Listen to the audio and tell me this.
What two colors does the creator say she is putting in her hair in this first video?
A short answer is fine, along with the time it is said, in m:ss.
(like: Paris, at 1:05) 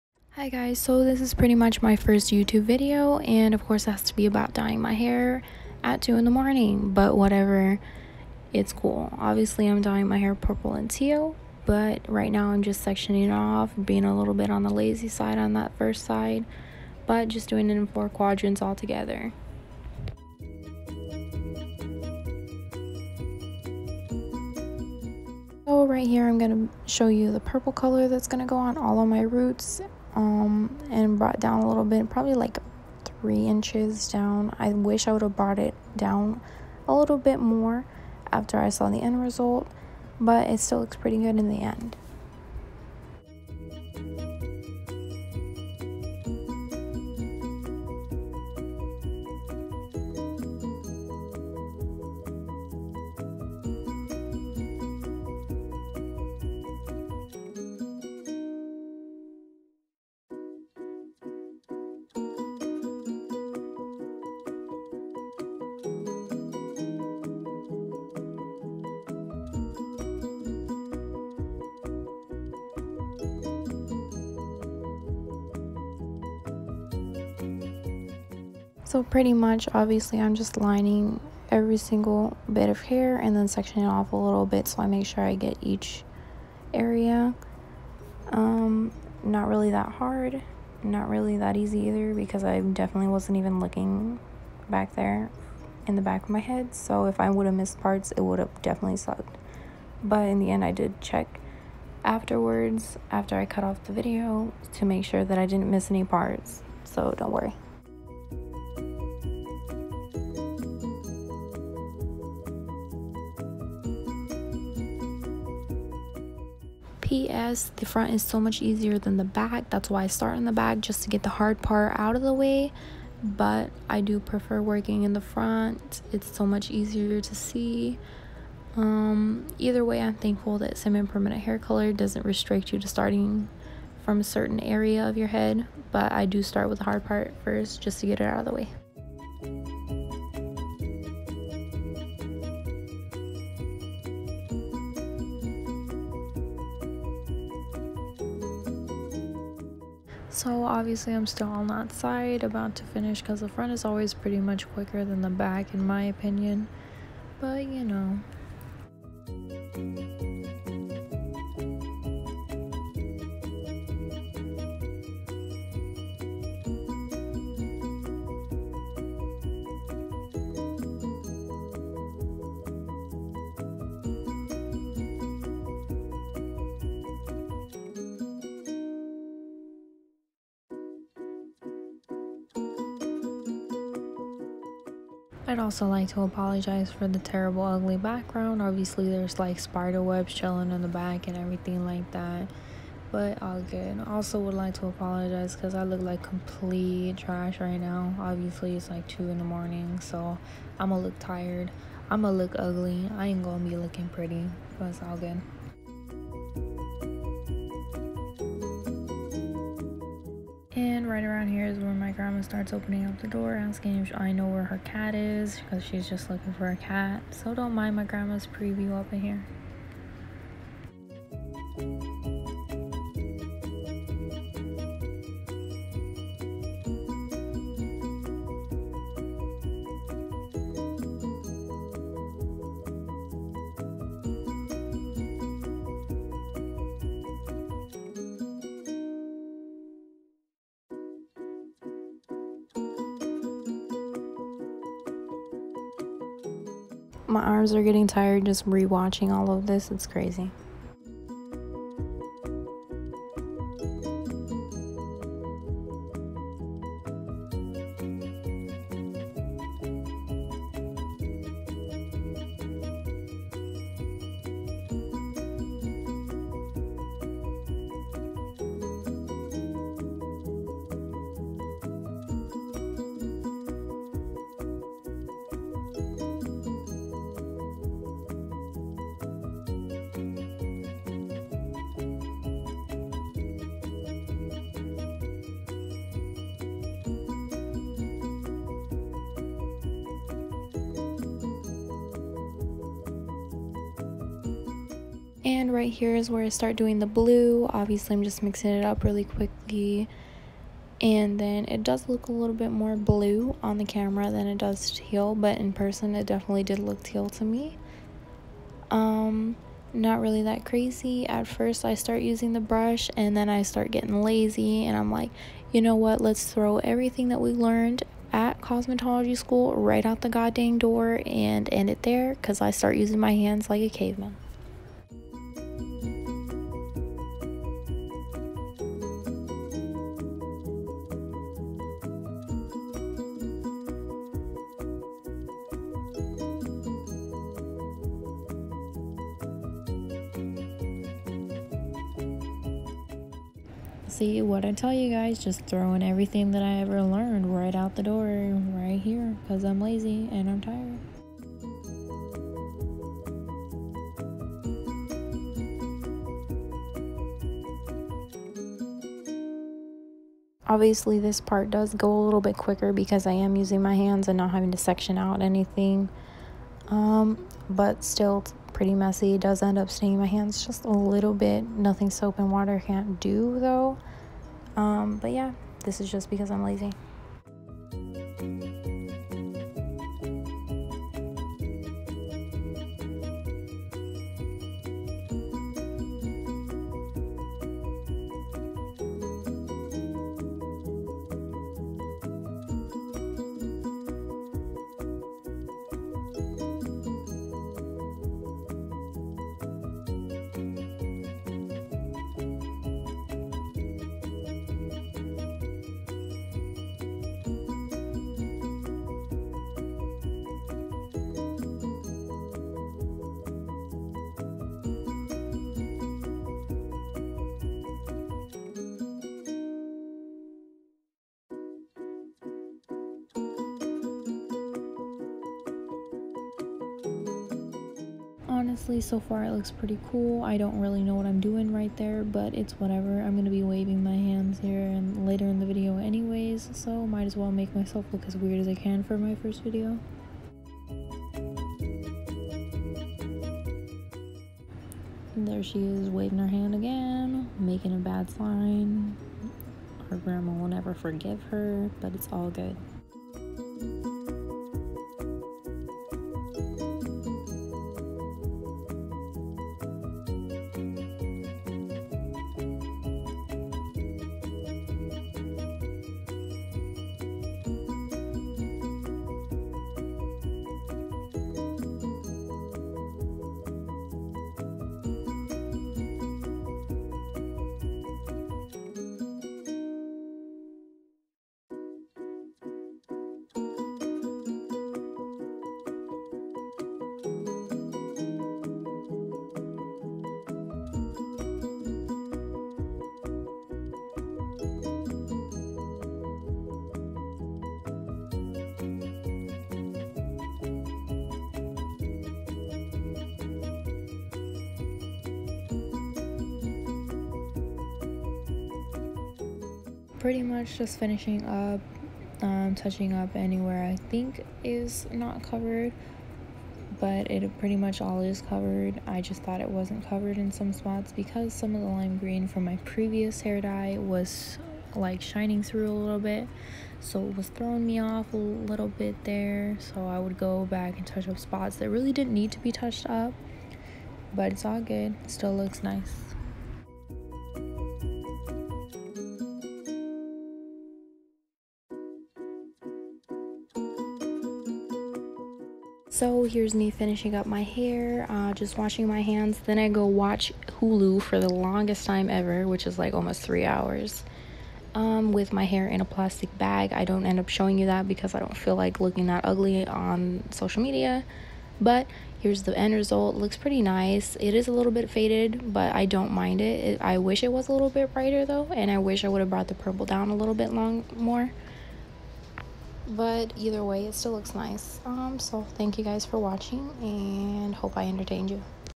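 purple and teal, at 0:10.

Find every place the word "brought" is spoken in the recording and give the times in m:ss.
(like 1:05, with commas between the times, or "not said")
0:31, 0:35, 9:29.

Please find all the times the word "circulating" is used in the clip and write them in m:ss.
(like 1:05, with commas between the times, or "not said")
not said.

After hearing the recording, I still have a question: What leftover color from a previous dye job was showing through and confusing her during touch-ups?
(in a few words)
lime green.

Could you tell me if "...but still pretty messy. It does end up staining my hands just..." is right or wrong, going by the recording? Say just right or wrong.
right.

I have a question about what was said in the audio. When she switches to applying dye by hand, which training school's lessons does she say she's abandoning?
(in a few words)
cosmetology school.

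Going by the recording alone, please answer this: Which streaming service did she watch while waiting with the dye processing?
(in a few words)
Hulu.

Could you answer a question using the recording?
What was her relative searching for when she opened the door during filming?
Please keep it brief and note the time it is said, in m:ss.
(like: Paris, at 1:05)
her cat, at 3:34.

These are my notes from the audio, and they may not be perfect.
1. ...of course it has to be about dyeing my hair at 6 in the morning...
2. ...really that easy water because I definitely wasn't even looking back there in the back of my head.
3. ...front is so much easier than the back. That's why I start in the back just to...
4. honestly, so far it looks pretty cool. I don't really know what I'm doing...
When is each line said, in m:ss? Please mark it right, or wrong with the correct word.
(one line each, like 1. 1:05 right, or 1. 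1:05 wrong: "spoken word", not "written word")
1. 0:03 wrong: "2", not "6"
2. 1:31 wrong: "either", not "water"
3. 1:57 right
4. 7:08 right.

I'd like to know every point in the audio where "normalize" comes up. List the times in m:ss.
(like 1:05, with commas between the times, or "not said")
not said.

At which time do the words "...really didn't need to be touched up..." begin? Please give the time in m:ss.
8:51.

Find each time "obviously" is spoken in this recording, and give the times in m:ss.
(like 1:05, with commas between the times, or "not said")
0:09, 1:19, 2:30, 3:08, 3:18, 4:57, 6:00.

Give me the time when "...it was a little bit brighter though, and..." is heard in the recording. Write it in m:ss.
9:27.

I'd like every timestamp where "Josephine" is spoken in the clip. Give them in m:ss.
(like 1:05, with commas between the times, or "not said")
not said.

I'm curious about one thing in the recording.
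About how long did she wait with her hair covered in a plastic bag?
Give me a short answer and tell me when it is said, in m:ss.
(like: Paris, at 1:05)
almost 3 hours, at 9:13.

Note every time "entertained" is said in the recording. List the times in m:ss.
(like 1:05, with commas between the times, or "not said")
9:38.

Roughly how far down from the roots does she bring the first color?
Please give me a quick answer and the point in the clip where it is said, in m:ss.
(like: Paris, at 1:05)
3 inches, at 0:33.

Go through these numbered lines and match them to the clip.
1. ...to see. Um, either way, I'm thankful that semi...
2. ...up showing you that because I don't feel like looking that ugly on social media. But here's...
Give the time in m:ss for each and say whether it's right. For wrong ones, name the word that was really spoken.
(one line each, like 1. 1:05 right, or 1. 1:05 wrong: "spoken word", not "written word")
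1. 2:07 right
2. 9:17 right.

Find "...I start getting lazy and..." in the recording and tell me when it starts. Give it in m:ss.
5:13.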